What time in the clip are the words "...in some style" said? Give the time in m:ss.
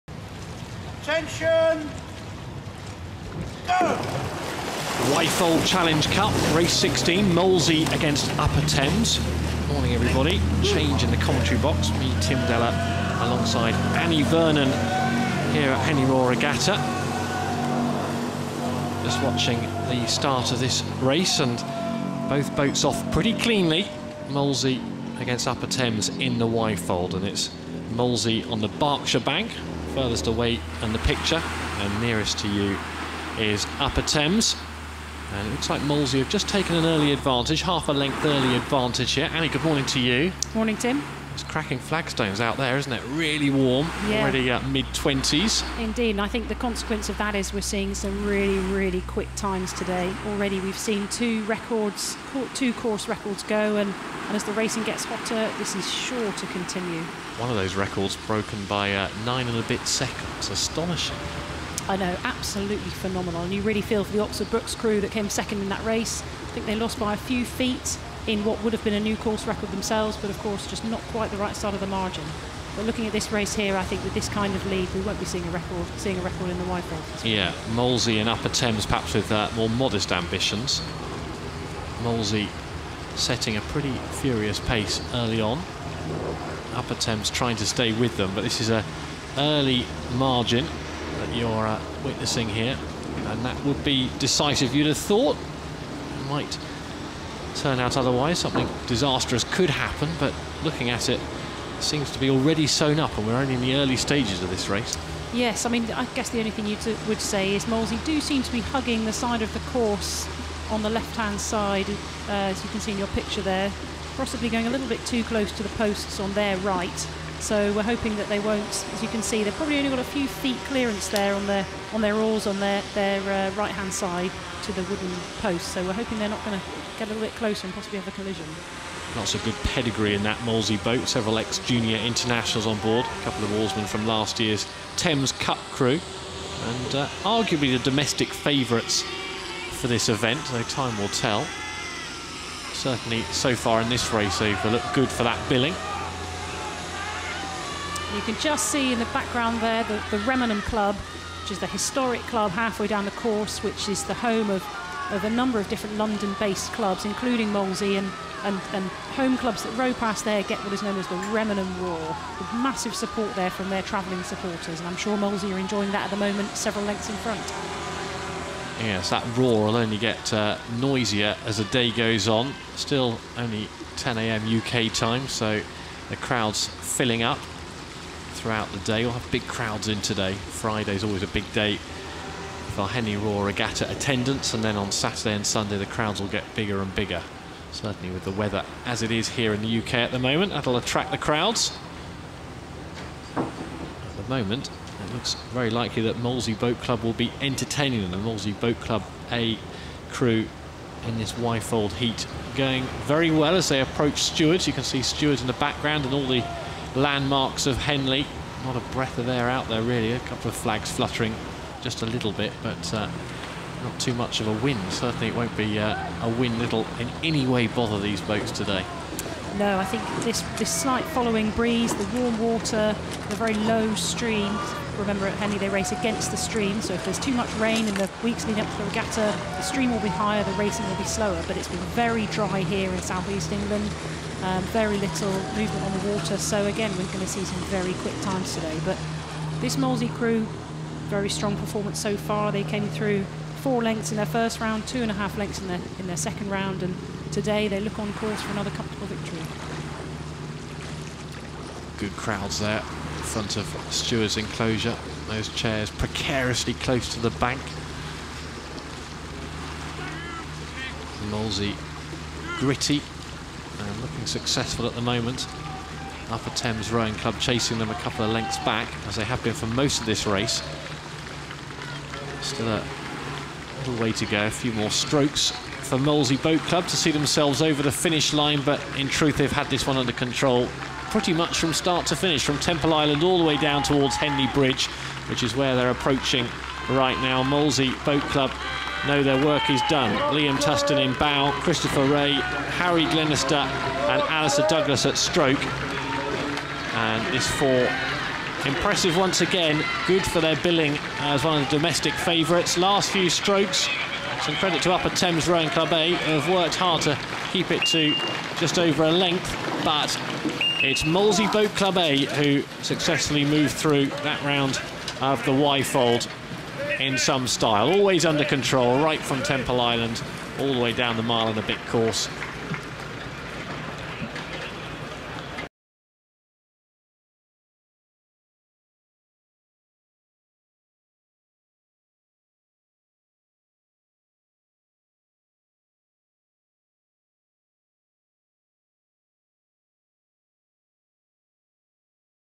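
5:17.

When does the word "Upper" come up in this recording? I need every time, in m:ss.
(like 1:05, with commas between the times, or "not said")
0:08, 0:25, 0:33, 1:18, 1:26, 4:26, 5:04.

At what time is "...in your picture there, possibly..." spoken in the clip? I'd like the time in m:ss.
1:52.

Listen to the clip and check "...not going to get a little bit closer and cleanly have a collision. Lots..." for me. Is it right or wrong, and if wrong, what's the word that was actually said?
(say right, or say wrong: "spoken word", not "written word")
wrong: "possibly", not "cleanly".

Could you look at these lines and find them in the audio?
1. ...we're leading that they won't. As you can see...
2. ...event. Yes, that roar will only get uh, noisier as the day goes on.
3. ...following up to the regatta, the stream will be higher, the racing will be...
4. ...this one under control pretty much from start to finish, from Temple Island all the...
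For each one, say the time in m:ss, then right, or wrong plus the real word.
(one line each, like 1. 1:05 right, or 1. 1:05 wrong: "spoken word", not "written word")
1. 1:57 wrong: "hoping", not "leading"
2. 2:47 wrong: "front", not "event"
3. 3:48 wrong: "leading", not "following"
4. 4:39 right.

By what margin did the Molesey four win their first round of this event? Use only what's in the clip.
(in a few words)
4 lengths.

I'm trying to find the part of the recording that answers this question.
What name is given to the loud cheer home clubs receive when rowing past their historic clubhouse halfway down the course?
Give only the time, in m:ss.
2:41.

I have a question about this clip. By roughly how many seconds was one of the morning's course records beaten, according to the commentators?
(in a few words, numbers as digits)
9.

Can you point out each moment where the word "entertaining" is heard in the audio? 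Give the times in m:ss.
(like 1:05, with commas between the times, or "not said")
3:17.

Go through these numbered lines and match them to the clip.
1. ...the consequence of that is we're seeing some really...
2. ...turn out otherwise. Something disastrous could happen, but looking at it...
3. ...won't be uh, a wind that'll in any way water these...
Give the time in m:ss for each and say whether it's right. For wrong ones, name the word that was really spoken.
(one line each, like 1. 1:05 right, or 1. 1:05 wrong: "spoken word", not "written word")
1. 0:46 right
2. 1:37 right
3. 3:35 wrong: "bother", not "water".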